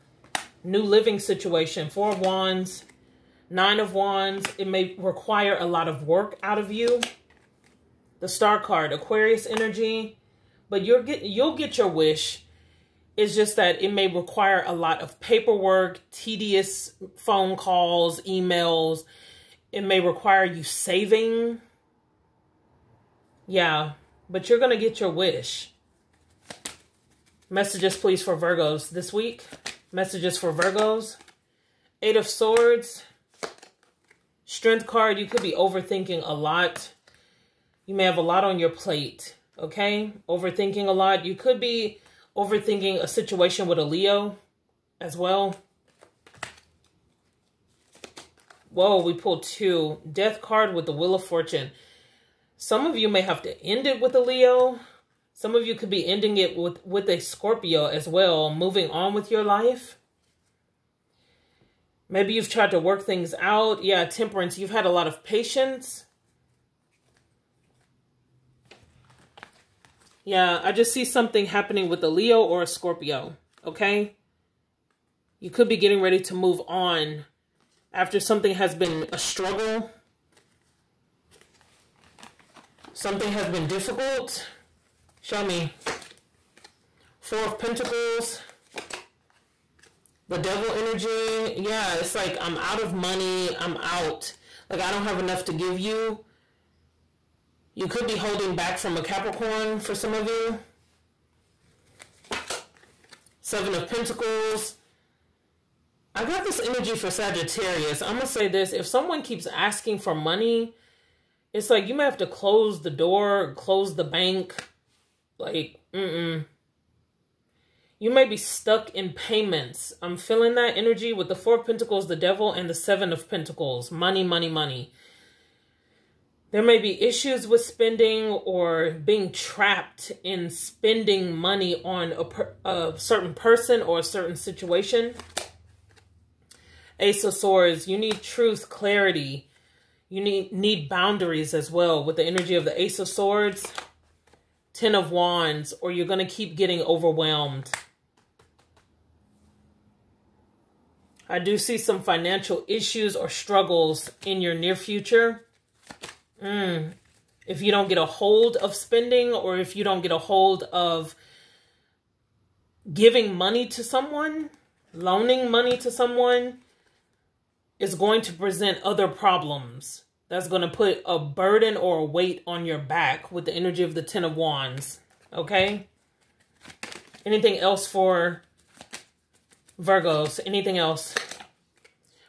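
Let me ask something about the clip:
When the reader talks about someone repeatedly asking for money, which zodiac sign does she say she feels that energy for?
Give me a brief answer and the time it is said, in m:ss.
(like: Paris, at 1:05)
Sagittarius, at 1:47.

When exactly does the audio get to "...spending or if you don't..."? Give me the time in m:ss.
2:38.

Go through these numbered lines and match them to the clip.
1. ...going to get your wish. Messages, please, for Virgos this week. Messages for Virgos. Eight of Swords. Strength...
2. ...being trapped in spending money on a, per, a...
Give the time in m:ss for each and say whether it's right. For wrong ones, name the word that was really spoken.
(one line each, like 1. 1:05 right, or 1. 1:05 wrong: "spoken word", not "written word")
1. 0:24 right
2. 2:08 right.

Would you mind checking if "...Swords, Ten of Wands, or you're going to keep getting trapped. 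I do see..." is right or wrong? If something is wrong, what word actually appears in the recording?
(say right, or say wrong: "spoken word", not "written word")
wrong: "overwhelmed", not "trapped".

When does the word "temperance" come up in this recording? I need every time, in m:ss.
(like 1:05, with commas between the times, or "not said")
1:04.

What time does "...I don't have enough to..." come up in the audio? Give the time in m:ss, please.
1:34.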